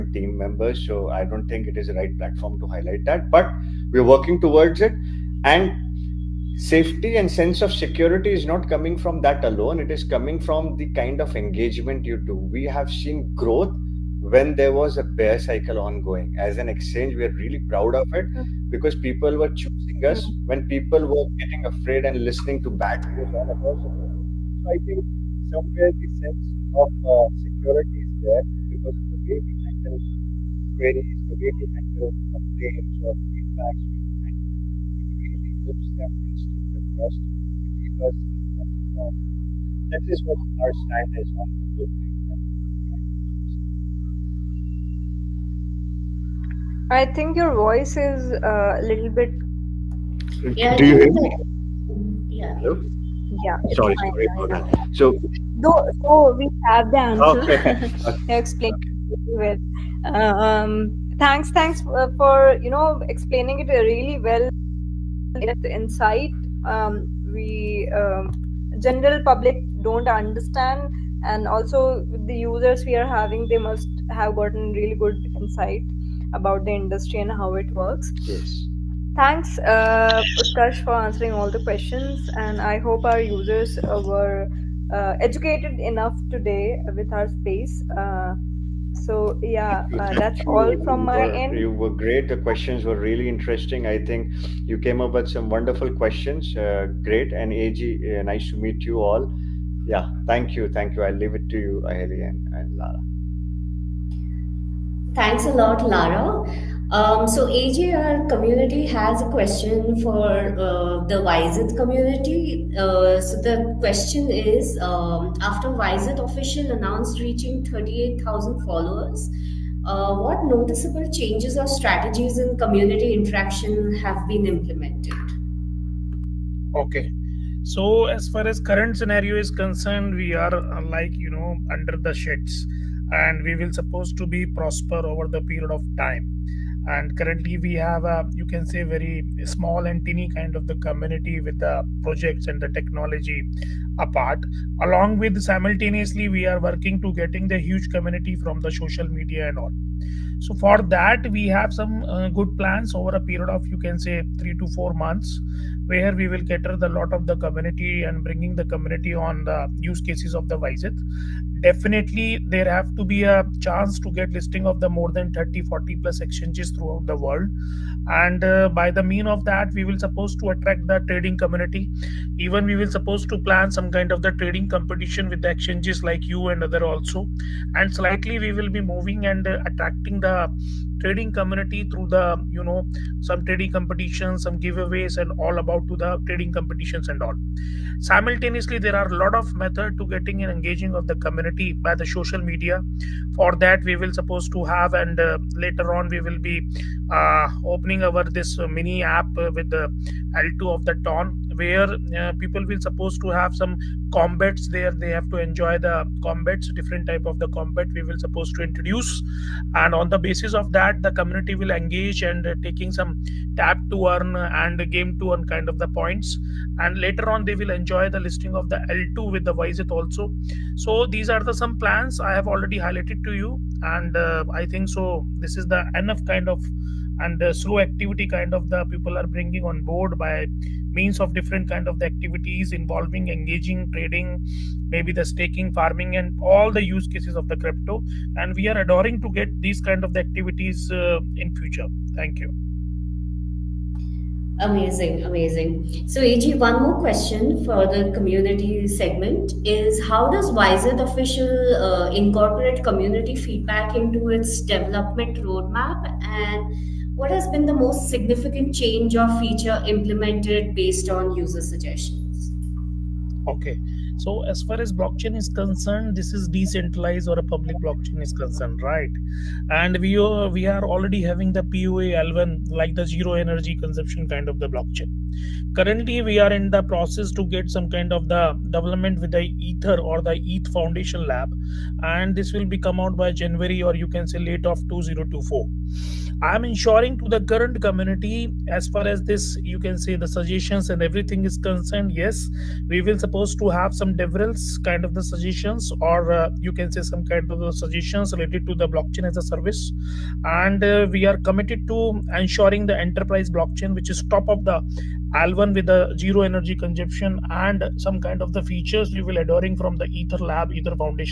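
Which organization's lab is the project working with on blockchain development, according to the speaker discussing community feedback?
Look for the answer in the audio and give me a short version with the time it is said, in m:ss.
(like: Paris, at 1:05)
ETH Foundation Lab, at 4:40.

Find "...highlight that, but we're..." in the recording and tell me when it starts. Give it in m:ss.
0:02.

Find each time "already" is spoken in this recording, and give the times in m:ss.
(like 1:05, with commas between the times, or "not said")
3:42, 4:30.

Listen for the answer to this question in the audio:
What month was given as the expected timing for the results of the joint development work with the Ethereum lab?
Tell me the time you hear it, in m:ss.
4:43.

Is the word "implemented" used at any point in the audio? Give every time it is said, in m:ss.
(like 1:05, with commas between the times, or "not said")
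2:04, 4:19.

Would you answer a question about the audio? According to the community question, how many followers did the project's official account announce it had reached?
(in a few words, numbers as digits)
38,000.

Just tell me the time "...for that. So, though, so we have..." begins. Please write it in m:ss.
0:54.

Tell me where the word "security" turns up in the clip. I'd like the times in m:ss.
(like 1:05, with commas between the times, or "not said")
0:07, 0:27.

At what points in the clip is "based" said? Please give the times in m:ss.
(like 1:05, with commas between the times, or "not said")
4:20.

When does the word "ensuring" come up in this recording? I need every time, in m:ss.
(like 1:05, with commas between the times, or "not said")
4:46, 5:02.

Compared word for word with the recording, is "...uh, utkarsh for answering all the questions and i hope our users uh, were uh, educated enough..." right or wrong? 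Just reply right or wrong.
right.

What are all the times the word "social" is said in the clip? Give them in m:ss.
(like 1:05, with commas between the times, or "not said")
2:28, 3:12.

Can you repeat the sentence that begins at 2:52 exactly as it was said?
Even we will suppose to plan some kind of the trading competition with the exchanges like you and other also.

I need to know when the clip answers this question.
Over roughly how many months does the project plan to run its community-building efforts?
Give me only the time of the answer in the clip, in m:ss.
2:34.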